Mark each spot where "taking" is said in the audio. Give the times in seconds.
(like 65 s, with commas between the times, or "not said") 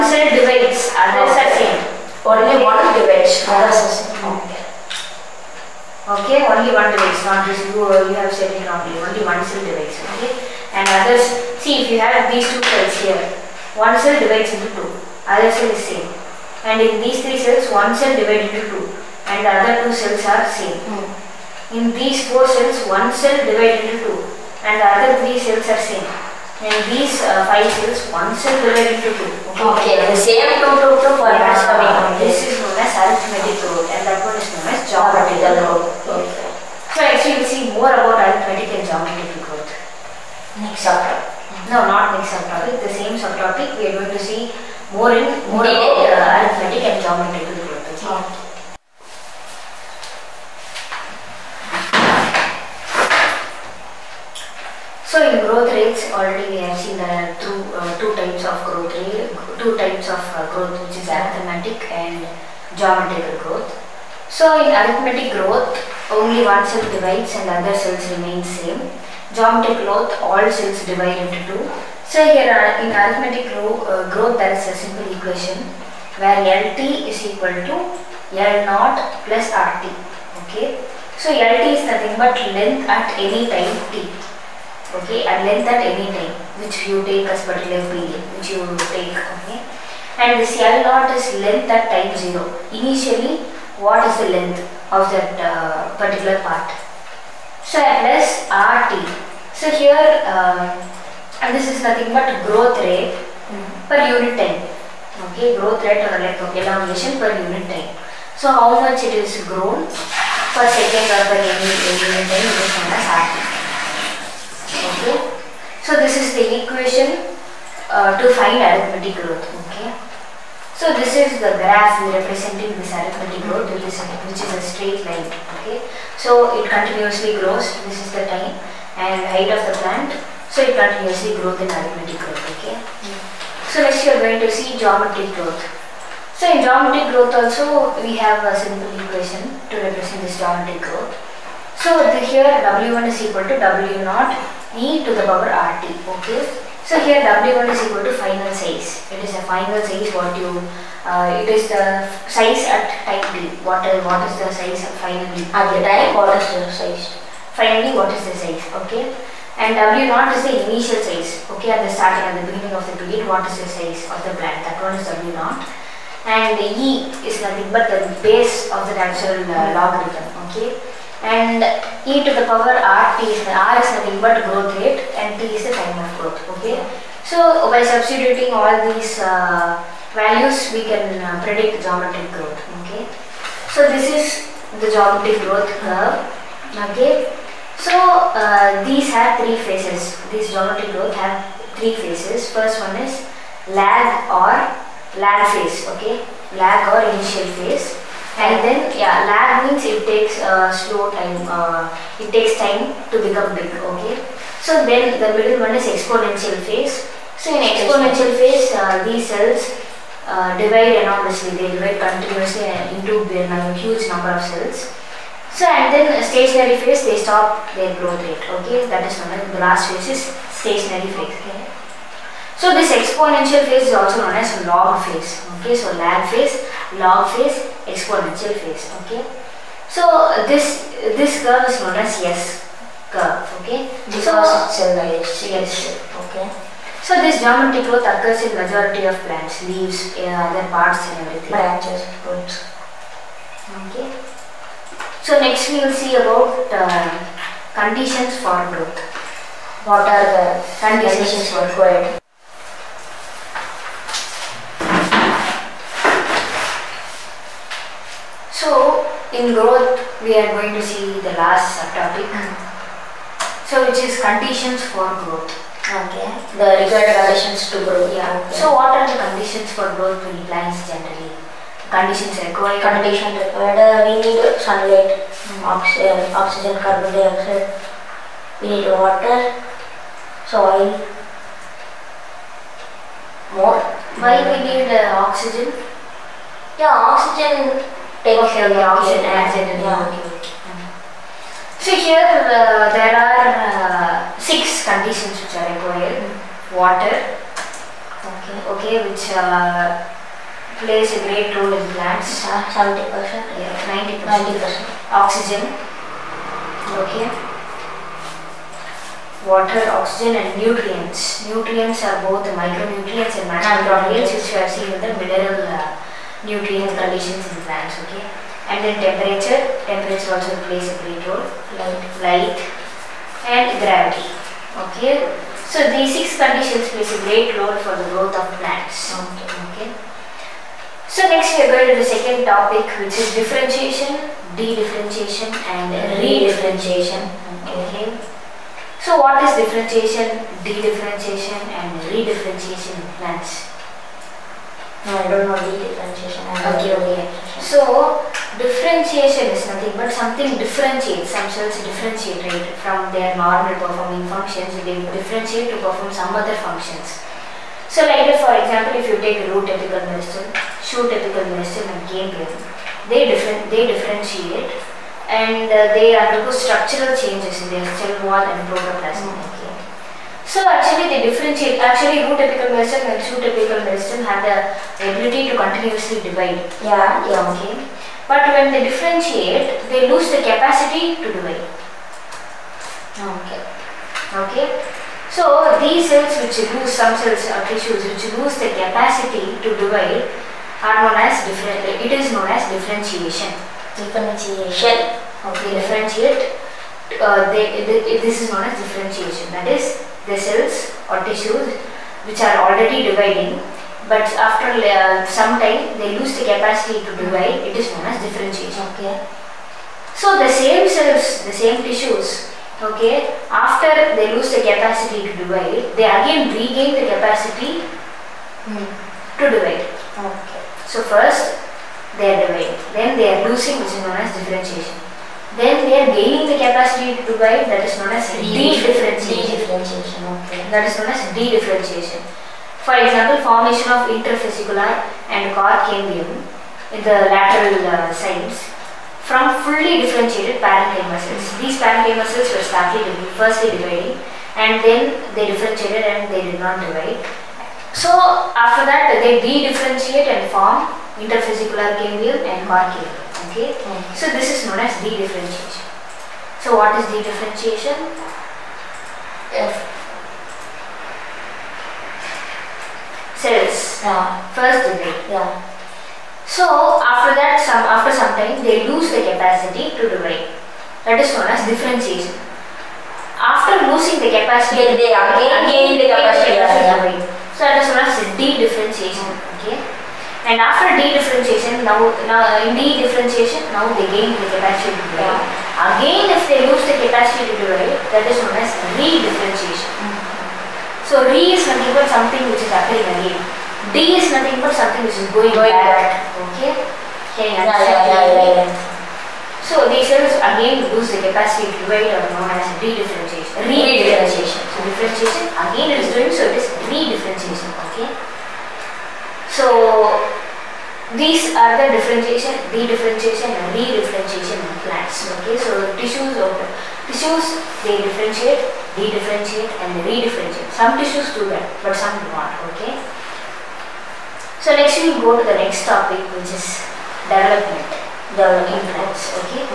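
288 s.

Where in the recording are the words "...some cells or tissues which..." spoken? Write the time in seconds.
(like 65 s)
386 s.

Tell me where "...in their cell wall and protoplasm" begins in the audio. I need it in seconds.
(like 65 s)
367 s.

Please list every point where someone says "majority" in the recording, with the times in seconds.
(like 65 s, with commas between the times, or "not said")
238 s.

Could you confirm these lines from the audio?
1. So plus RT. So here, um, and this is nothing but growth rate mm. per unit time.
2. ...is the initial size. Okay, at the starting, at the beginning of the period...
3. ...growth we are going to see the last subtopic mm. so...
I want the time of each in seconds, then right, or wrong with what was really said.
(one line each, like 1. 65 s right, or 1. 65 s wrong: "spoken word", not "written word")
1. 97 s right
2. 160 s right
3. 259 s right.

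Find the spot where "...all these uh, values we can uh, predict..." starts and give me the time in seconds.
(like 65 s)
178 s.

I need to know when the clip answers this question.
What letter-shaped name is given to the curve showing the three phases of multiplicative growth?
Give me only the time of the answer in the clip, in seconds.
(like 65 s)
232 s.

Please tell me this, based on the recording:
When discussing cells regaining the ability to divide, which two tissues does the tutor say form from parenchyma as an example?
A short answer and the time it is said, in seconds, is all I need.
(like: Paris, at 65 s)
interfascicular and cork cambium, at 434 s.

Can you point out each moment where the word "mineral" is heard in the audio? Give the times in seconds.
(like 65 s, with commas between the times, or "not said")
315 s.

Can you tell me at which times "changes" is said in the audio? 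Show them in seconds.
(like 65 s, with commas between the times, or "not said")
367 s.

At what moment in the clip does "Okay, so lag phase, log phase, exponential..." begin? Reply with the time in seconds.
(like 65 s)
225 s.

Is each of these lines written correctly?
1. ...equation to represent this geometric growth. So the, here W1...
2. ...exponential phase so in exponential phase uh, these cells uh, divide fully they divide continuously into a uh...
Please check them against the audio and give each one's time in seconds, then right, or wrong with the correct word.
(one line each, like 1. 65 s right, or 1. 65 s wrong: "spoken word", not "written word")
1. 138 s right
2. 205 s wrong: "enormously", not "fully".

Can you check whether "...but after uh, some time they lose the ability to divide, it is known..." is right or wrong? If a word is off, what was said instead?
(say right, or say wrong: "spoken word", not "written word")
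wrong: "capacity", not "ability".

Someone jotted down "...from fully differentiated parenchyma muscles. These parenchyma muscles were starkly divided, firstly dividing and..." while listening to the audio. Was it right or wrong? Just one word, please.
right.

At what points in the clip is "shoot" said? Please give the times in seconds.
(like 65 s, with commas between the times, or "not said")
360 s, 373 s.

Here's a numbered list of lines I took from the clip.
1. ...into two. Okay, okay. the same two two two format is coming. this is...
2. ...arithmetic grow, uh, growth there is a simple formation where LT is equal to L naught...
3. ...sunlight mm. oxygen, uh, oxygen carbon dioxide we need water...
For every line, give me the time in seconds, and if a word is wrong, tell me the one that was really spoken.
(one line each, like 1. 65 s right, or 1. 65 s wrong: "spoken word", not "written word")
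1. 29 s right
2. 72 s wrong: "equation", not "formation"
3. 274 s right.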